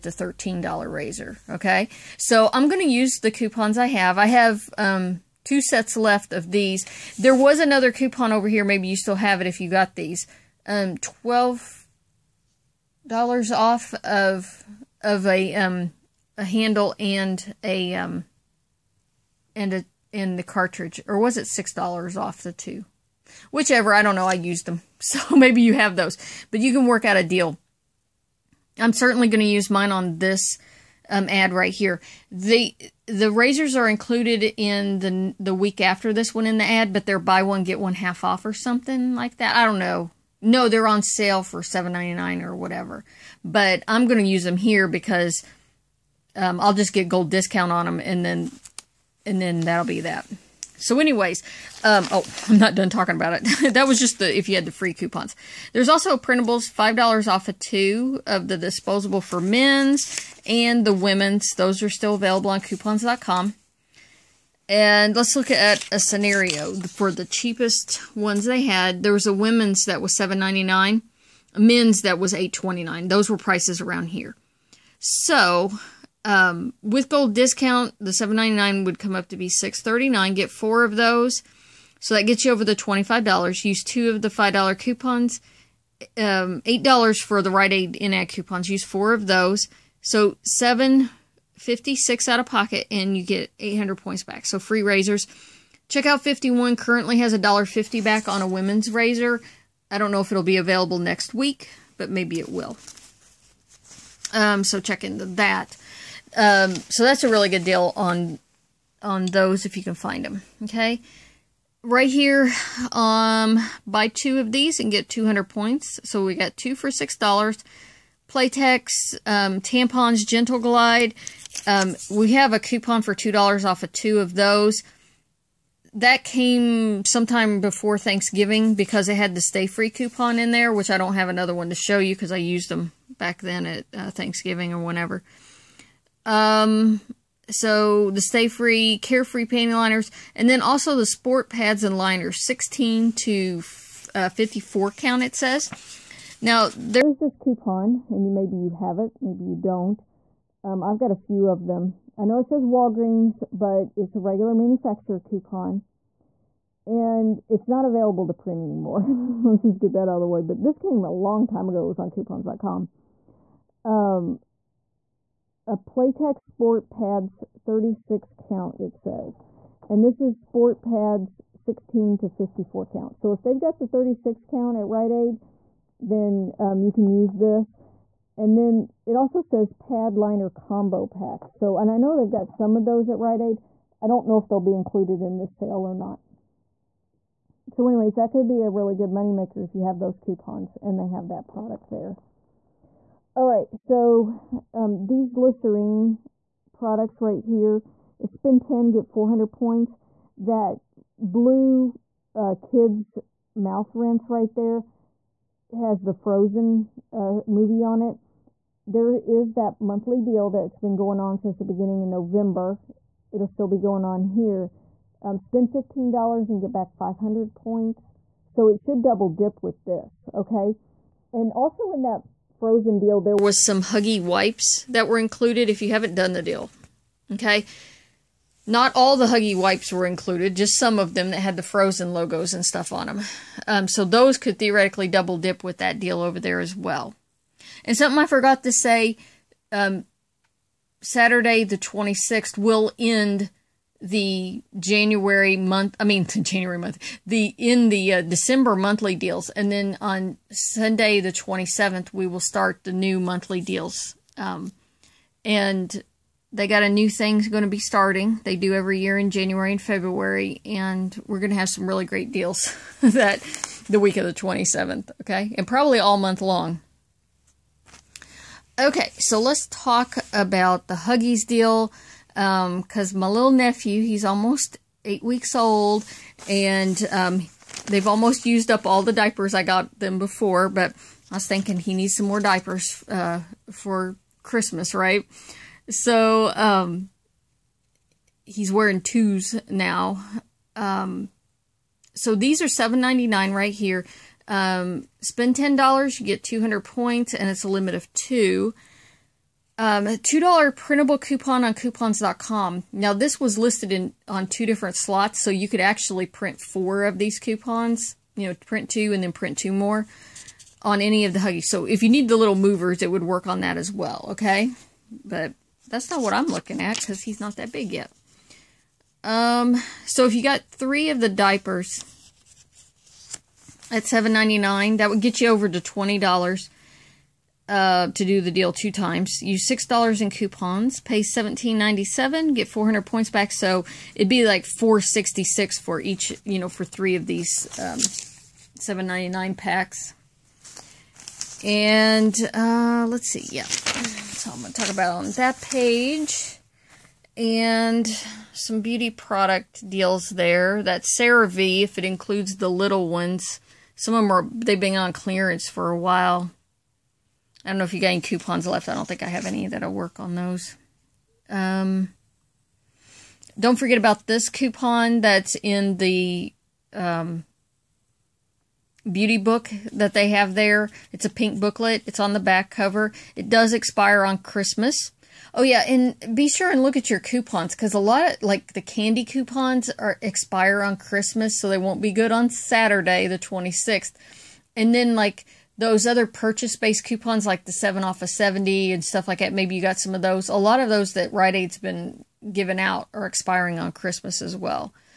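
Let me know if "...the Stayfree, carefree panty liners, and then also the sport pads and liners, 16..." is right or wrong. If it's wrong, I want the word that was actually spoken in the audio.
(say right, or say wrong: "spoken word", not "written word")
right.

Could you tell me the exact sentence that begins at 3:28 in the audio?
There is that monthly deal that's been going on since the beginning of November.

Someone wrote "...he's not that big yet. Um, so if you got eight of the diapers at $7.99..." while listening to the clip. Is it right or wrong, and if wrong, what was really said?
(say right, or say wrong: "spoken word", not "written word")
wrong: "three", not "eight".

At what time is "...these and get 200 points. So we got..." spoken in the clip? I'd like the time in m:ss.
1:54.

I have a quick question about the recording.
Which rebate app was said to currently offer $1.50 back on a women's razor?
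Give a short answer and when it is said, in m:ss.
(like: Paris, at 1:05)
Checkout 51, at 1:35.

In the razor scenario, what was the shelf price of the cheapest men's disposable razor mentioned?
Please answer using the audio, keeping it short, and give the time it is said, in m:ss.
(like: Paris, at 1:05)
$8.29, at 1:12.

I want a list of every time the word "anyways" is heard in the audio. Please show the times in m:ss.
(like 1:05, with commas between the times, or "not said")
0:51, 3:07.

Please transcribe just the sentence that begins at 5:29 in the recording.
Use $6 in coupons, pay $17.97, get 400 points back.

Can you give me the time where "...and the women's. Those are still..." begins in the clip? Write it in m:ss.
1:00.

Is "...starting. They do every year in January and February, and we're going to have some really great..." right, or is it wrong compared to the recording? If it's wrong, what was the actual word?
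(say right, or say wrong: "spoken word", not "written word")
right.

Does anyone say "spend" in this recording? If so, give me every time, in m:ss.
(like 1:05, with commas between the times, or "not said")
3:18, 3:35, 4:55.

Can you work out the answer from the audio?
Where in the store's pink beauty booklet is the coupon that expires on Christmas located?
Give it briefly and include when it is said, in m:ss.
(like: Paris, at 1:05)
the back cover, at 6:12.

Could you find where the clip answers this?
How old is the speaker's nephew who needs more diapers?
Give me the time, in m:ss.
4:34.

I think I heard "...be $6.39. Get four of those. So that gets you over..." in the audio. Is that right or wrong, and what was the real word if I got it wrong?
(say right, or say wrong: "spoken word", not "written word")
right.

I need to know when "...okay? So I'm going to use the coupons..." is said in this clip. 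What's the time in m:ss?
0:01.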